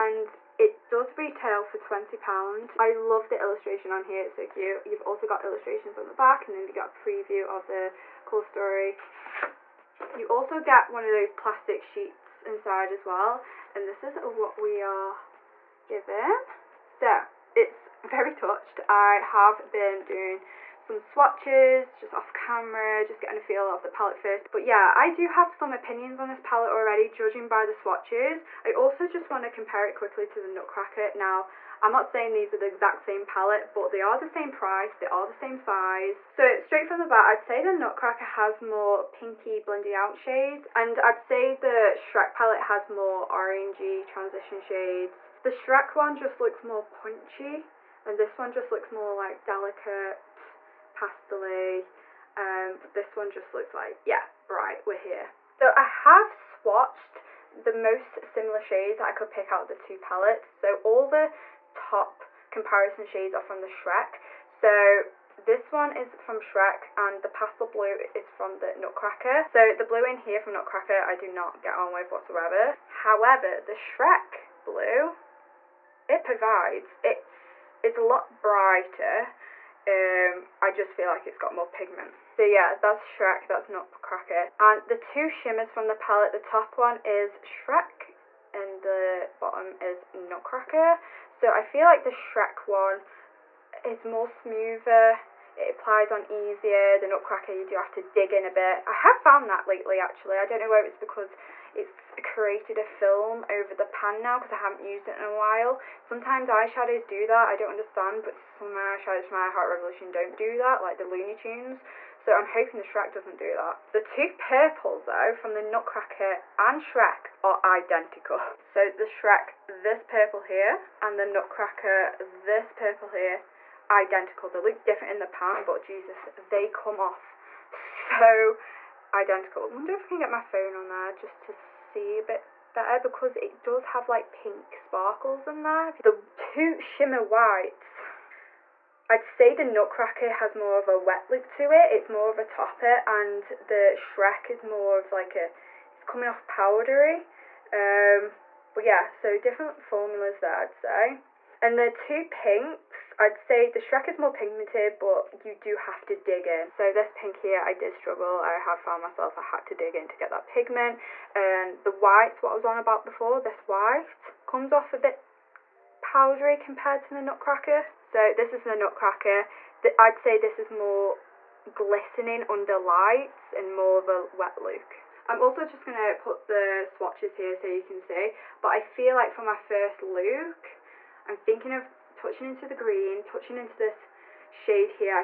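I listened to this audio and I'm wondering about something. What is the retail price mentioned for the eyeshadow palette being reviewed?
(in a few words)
£20.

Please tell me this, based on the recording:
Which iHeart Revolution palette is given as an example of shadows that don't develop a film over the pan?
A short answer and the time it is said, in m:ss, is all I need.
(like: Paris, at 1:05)
Looney Tunes, at 1:51.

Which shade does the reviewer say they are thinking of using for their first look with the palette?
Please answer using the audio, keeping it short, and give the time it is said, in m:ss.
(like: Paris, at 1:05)
green, at 3:02.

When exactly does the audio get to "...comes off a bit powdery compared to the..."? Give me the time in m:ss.
2:44.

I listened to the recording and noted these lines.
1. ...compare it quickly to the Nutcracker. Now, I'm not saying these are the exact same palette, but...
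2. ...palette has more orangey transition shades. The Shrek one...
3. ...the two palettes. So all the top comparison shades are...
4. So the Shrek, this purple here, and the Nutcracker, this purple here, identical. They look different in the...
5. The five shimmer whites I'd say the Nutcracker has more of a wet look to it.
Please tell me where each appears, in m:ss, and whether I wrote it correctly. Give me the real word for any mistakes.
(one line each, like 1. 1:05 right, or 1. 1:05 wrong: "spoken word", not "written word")
1. 0:29 right
2. 0:42 right
3. 0:59 right
4. 1:58 right
5. 2:15 wrong: "two", not "five".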